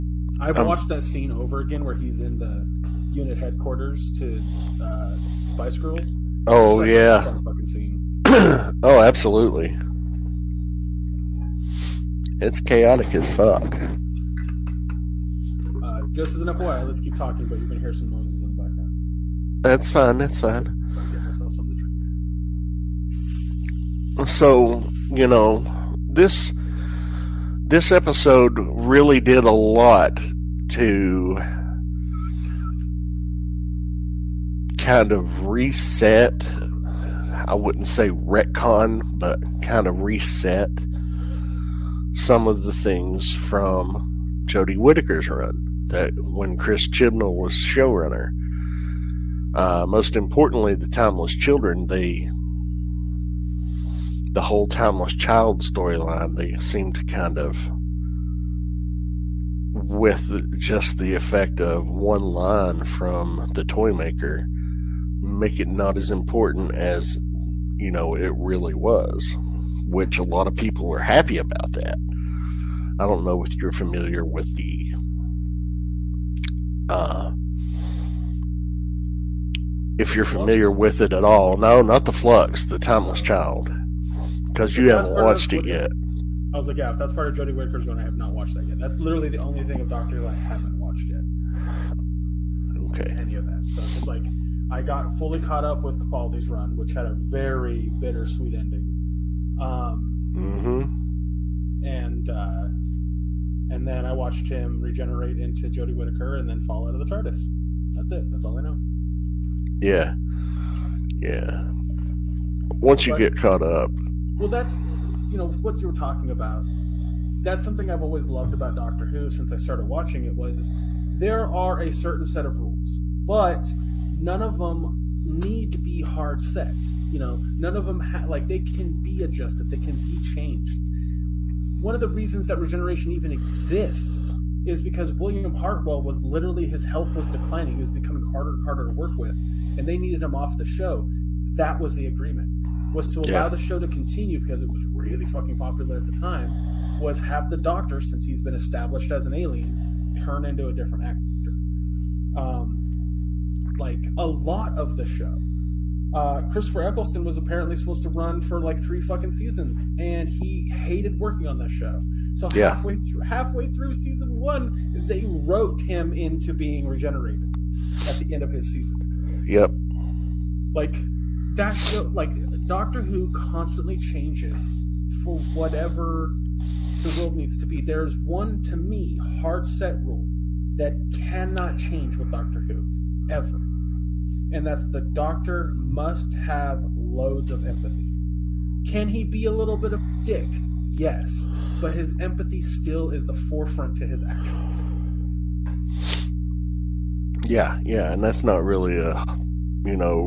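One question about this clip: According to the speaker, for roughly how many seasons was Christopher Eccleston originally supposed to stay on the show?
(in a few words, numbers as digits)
3.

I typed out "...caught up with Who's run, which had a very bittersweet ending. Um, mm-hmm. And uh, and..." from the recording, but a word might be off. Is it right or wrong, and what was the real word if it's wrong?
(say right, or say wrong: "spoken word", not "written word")
wrong: "Capaldi", not "Who".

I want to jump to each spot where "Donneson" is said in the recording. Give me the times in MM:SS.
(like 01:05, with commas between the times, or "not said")
not said.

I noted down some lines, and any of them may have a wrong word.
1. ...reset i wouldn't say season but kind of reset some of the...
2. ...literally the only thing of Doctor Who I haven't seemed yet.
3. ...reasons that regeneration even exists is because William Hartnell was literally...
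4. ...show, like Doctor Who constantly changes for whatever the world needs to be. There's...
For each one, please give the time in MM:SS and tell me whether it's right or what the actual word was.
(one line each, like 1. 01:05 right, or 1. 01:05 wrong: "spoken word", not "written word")
1. 00:35 wrong: "retcon", not "season"
2. 01:28 wrong: "watched", not "seemed"
3. 02:12 right
4. 02:51 right.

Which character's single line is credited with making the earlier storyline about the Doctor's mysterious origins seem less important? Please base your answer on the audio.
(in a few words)
the Toy Maker.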